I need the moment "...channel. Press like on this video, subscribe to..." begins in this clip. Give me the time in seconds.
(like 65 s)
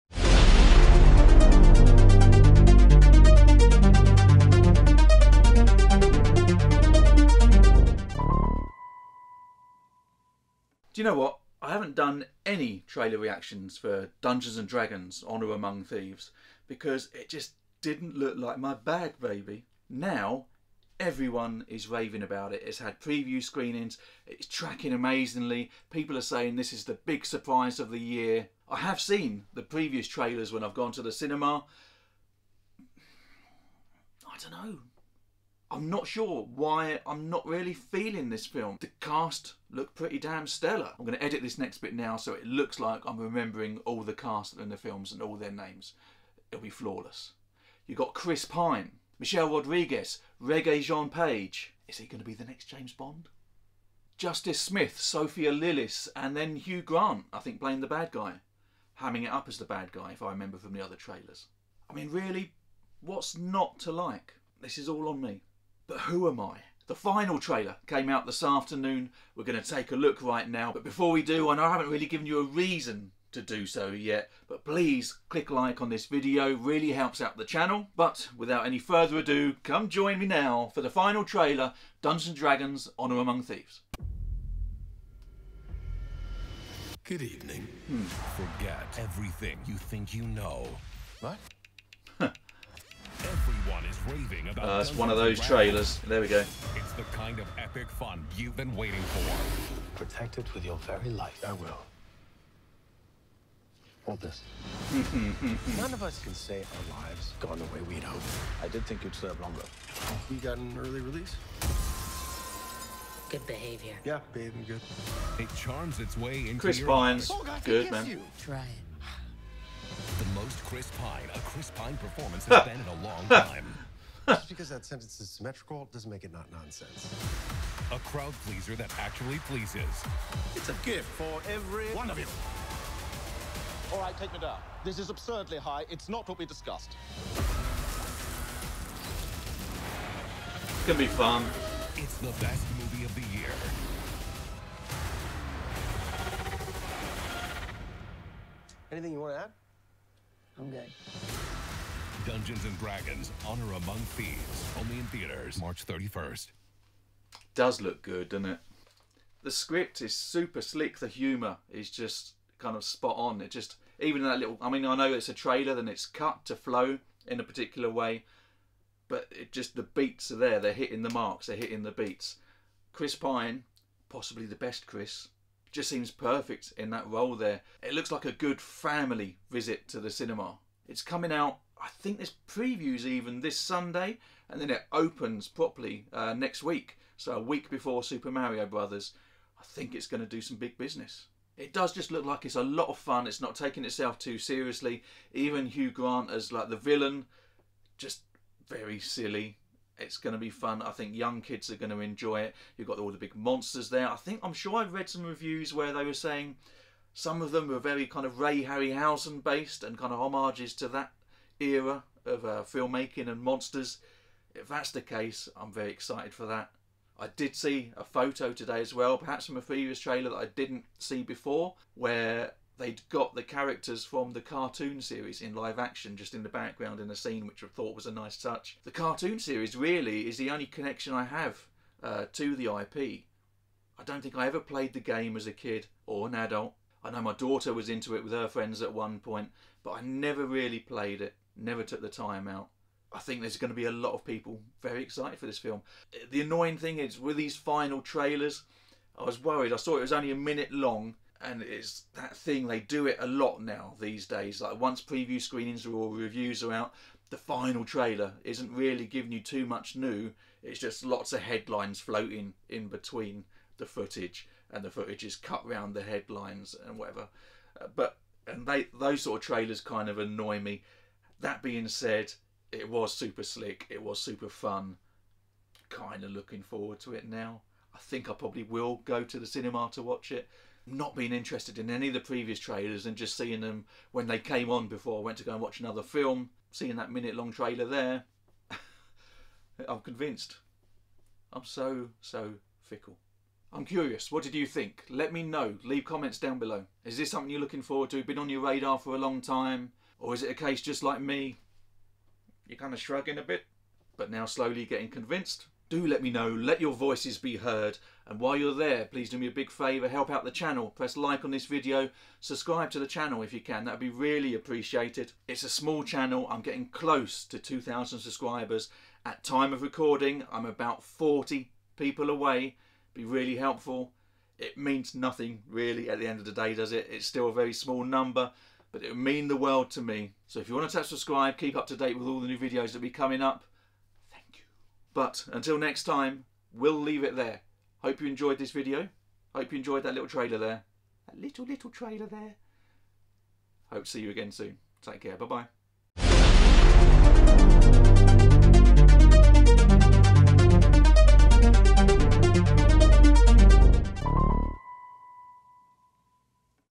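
310 s.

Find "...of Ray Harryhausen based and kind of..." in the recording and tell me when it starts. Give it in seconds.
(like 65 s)
208 s.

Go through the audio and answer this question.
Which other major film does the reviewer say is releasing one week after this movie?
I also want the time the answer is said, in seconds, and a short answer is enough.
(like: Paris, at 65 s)
Super Mario Brothers, at 188 s.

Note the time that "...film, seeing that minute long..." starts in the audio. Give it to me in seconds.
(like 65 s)
286 s.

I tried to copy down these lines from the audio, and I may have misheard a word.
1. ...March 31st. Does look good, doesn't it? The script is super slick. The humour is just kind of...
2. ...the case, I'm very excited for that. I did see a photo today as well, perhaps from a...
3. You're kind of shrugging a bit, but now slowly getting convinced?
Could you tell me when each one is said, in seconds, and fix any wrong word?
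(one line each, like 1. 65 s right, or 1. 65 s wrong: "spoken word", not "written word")
1. 155 s right
2. 214 s right
3. 302 s right.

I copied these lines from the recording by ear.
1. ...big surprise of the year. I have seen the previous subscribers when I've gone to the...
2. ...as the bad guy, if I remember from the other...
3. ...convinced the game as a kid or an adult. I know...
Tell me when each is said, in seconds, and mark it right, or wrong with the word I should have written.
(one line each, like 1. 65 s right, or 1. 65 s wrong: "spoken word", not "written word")
1. 27 s wrong: "trailers", not "subscribers"
2. 59 s right
3. 234 s wrong: "played", not "convinced".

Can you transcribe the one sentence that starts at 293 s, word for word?
I'm curious, what did you think?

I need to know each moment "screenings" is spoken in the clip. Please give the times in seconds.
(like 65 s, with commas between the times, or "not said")
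23 s, 255 s.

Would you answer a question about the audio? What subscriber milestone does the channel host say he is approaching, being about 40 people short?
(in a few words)
2,000.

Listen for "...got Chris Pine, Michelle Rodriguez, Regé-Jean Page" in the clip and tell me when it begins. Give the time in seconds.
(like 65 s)
47 s.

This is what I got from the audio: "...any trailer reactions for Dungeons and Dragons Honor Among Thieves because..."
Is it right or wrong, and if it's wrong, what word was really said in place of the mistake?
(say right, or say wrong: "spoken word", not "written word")
right.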